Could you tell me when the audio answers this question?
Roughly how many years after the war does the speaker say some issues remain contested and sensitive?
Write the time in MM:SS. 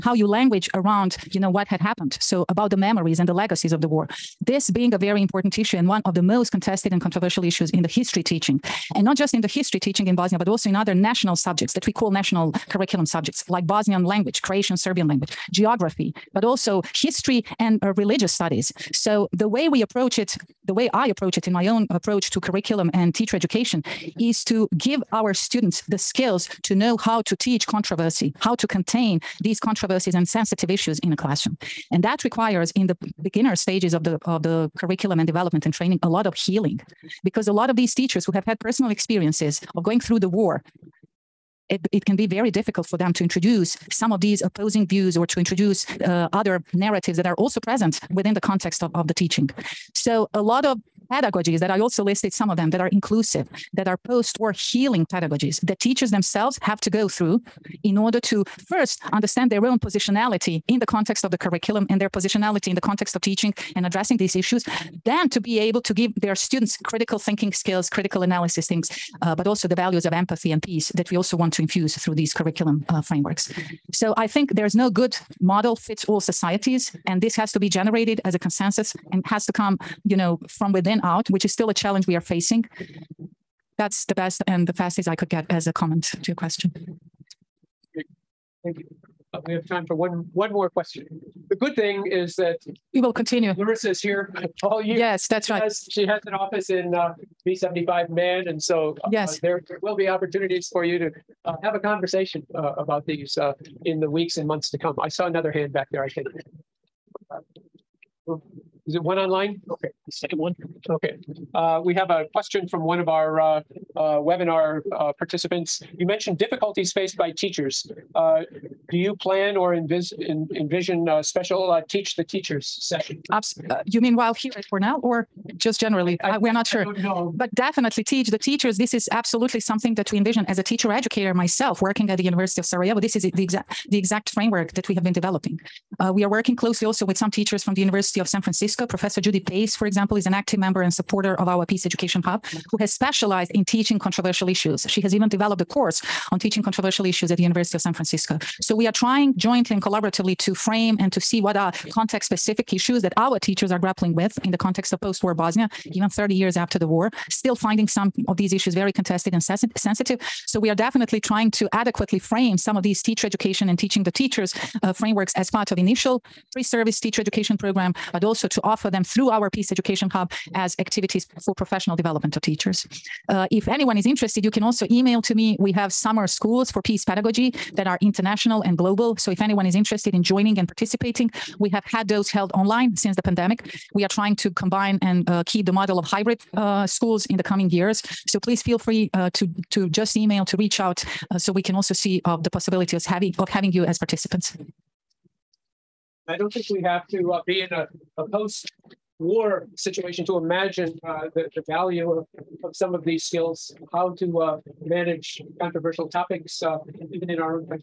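02:36.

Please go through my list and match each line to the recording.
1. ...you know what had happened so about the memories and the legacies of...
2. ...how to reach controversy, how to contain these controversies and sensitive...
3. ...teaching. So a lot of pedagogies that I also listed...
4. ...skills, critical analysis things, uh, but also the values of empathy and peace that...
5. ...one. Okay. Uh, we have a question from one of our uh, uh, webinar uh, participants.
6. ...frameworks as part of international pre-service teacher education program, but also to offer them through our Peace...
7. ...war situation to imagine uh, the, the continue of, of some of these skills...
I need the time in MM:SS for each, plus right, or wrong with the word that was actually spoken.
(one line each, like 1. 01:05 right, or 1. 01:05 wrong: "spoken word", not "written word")
1. 00:01 right
2. 00:26 wrong: "teach", not "reach"
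3. 00:49 right
4. 01:07 right
5. 01:50 right
6. 02:44 wrong: "initial", not "international"
7. 03:19 wrong: "value", not "continue".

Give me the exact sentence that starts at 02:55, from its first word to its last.
We have summer schools for peace pedagogy that are international and global.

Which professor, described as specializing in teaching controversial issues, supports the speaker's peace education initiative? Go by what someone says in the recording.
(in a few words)
Judy Pace.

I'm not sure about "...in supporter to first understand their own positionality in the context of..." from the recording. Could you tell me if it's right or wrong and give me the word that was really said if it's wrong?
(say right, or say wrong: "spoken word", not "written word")
wrong: "order", not "supporter".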